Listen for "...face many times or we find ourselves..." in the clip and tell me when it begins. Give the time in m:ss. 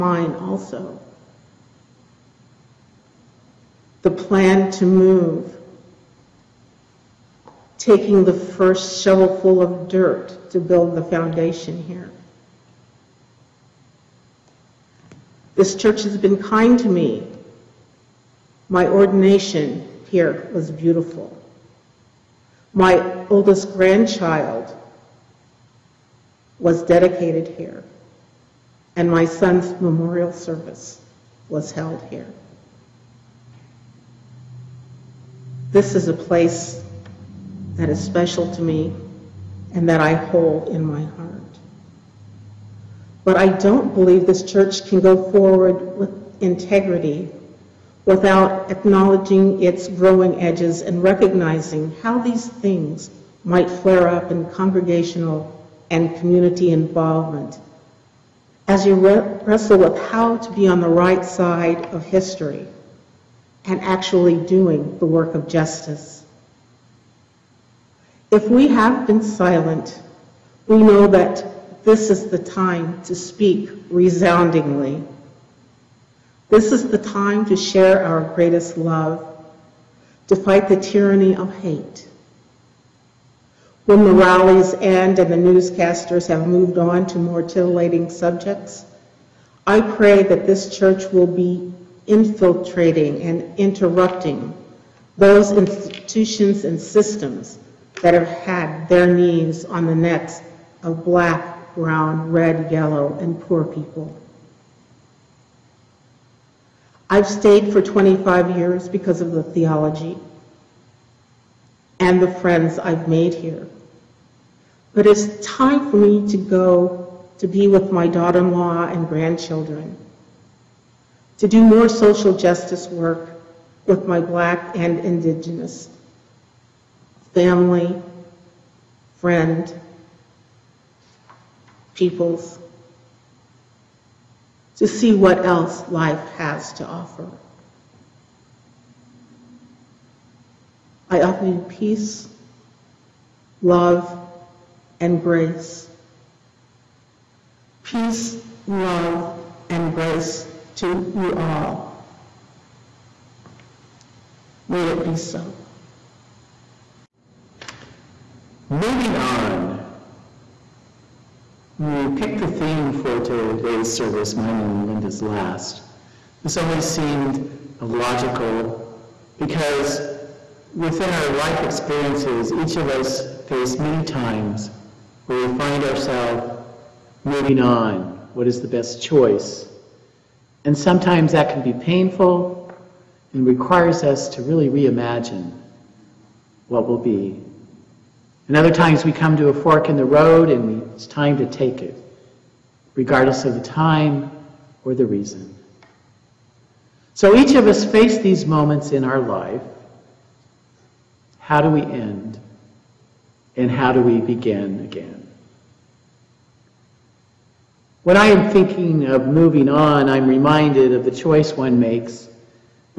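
2:53.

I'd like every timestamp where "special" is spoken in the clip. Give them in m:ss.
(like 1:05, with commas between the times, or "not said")
0:38.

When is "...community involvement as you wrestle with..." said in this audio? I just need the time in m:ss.
0:56.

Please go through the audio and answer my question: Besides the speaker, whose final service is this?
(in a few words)
Lynnda.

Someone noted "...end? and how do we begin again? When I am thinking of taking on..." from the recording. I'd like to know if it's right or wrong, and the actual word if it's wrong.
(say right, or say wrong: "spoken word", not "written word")
wrong: "moving", not "taking".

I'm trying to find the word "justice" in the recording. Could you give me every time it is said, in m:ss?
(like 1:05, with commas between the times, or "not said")
1:05, 2:02.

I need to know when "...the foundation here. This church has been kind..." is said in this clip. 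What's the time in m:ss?
0:10.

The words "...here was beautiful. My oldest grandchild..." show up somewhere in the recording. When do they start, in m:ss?
0:20.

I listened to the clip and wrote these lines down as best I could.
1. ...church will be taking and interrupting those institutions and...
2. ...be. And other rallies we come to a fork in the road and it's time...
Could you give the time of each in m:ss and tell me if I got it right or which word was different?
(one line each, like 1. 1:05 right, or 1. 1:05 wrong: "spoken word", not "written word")
1. 1:30 wrong: "infiltrating", not "taking"
2. 3:06 wrong: "times", not "rallies".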